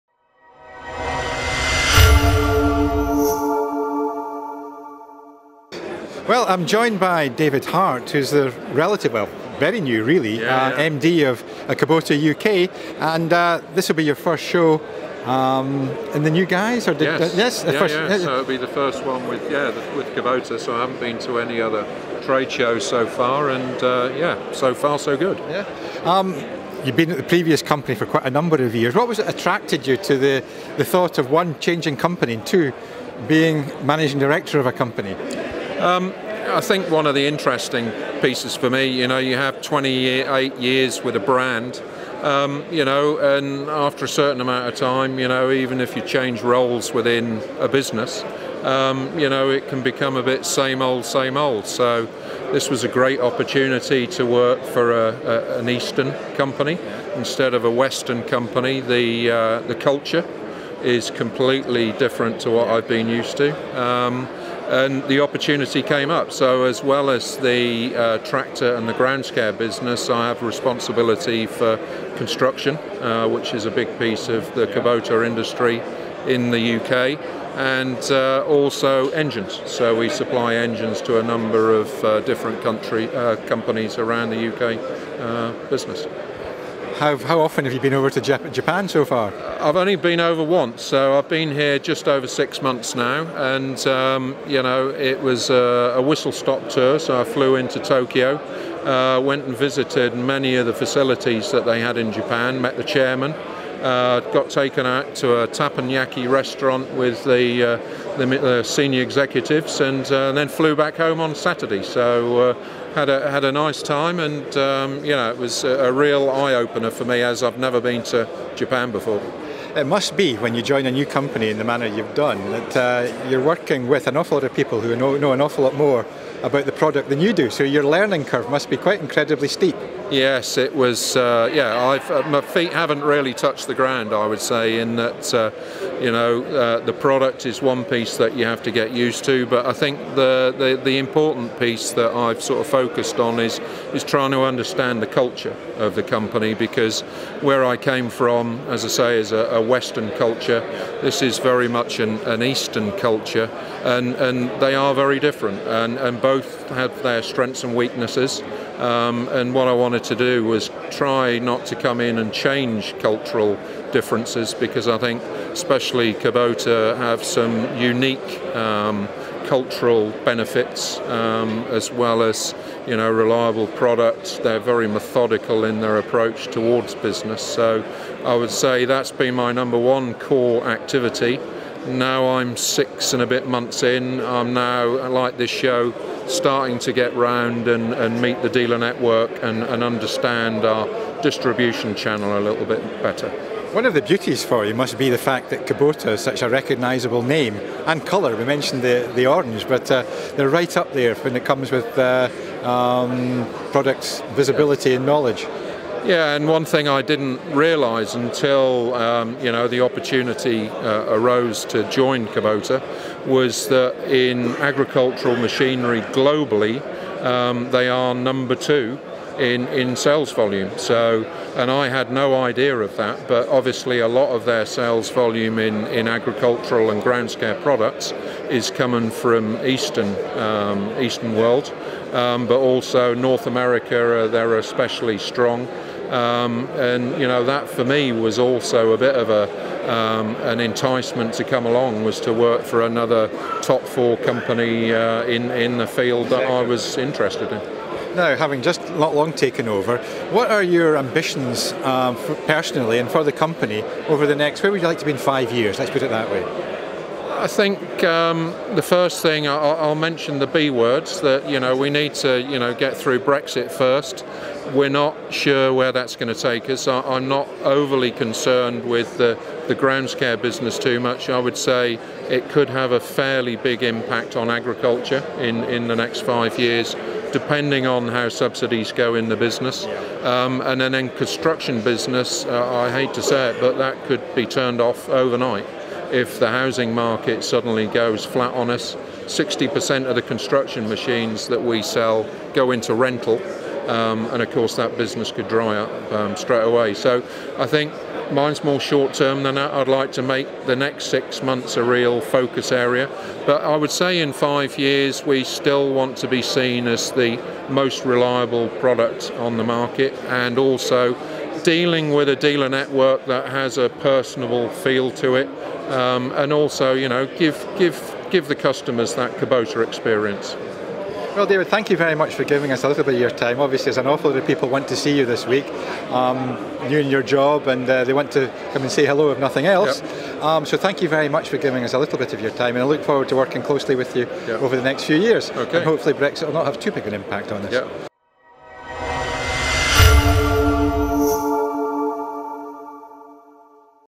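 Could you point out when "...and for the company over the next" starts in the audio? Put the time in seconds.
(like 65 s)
252 s.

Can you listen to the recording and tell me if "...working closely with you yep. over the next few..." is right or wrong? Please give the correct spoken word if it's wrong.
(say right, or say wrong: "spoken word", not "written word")
right.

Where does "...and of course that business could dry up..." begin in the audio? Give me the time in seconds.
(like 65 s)
294 s.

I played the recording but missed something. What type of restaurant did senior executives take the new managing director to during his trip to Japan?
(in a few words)
Teppanyaki.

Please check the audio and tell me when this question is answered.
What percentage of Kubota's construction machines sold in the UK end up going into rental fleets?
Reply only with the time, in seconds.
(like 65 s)
289 s.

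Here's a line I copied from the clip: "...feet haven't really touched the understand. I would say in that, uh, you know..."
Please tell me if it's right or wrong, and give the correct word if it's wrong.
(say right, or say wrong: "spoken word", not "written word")
wrong: "ground", not "understand".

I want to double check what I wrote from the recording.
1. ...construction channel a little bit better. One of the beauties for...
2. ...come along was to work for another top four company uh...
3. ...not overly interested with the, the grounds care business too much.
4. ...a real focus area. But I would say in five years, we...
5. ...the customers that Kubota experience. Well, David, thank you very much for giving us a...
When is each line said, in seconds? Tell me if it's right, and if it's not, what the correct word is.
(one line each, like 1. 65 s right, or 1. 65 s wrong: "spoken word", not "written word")
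1. 191 s wrong: "distribution", not "construction"
2. 241 s right
3. 267 s wrong: "concerned", not "interested"
4. 301 s right
5. 318 s right.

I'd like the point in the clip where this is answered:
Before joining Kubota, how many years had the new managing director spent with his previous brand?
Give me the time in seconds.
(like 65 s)
39 s.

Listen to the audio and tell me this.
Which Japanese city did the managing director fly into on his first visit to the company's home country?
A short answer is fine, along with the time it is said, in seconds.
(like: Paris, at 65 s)
Tokyo, at 97 s.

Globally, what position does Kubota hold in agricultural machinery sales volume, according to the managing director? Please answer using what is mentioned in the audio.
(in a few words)
Number two.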